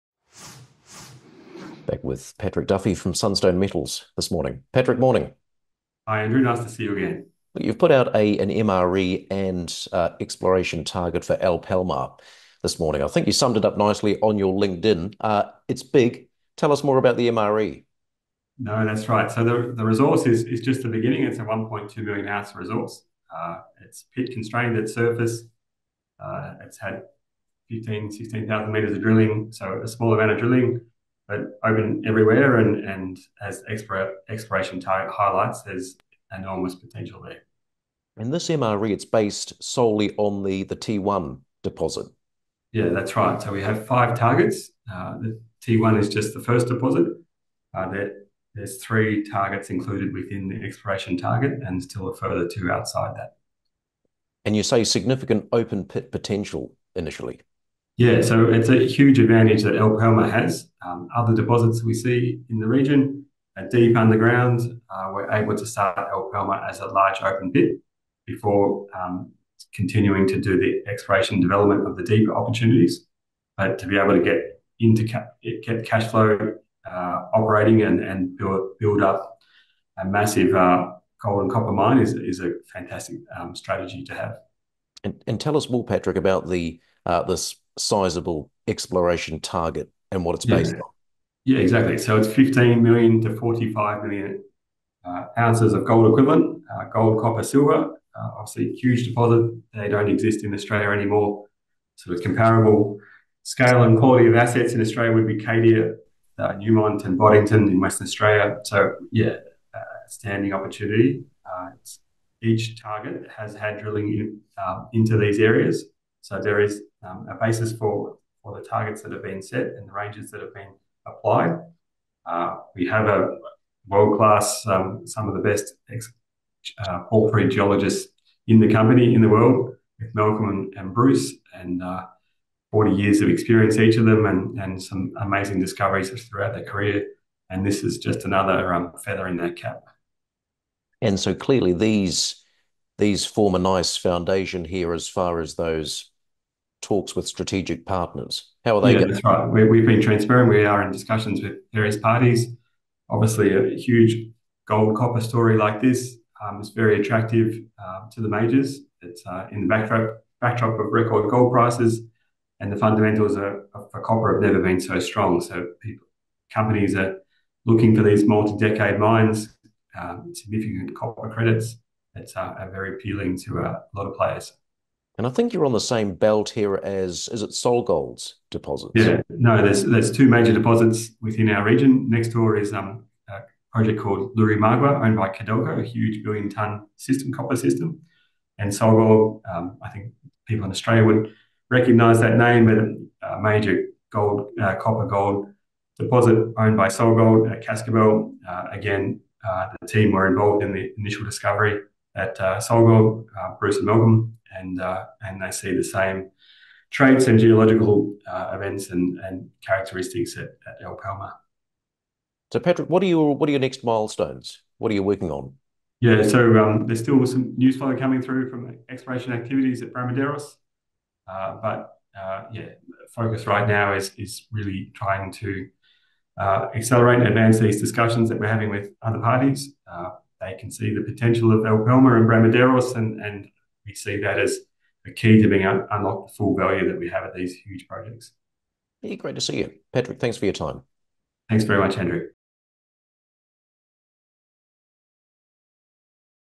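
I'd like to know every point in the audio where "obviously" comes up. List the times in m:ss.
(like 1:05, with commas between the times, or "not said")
1:38, 2:33.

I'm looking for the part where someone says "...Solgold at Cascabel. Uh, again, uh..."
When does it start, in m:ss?
3:16.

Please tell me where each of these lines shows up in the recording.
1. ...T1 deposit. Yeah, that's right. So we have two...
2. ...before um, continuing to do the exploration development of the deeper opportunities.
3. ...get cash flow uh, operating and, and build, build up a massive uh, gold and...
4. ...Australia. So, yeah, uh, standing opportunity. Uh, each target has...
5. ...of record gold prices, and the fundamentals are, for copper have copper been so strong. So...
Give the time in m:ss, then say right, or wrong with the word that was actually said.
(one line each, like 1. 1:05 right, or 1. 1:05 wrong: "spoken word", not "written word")
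1. 0:40 wrong: "five", not "two"
2. 1:08 right
3. 1:15 right
4. 1:48 right
5. 2:40 wrong: "never", not "copper".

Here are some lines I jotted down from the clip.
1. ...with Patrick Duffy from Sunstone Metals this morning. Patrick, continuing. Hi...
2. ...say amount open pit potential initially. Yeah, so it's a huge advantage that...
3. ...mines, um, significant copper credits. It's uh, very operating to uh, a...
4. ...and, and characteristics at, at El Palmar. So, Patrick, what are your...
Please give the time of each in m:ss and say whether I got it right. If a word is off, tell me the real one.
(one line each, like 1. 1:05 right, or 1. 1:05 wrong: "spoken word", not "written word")
1. 0:02 wrong: "morning", not "continuing"
2. 0:54 wrong: "significant", not "amount"
3. 2:48 wrong: "appealing", not "operating"
4. 3:28 right.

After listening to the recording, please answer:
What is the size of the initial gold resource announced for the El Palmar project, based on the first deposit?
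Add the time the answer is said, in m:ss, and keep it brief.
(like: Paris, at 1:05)
1.2 million ounces, at 0:21.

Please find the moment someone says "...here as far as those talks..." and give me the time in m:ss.
2:24.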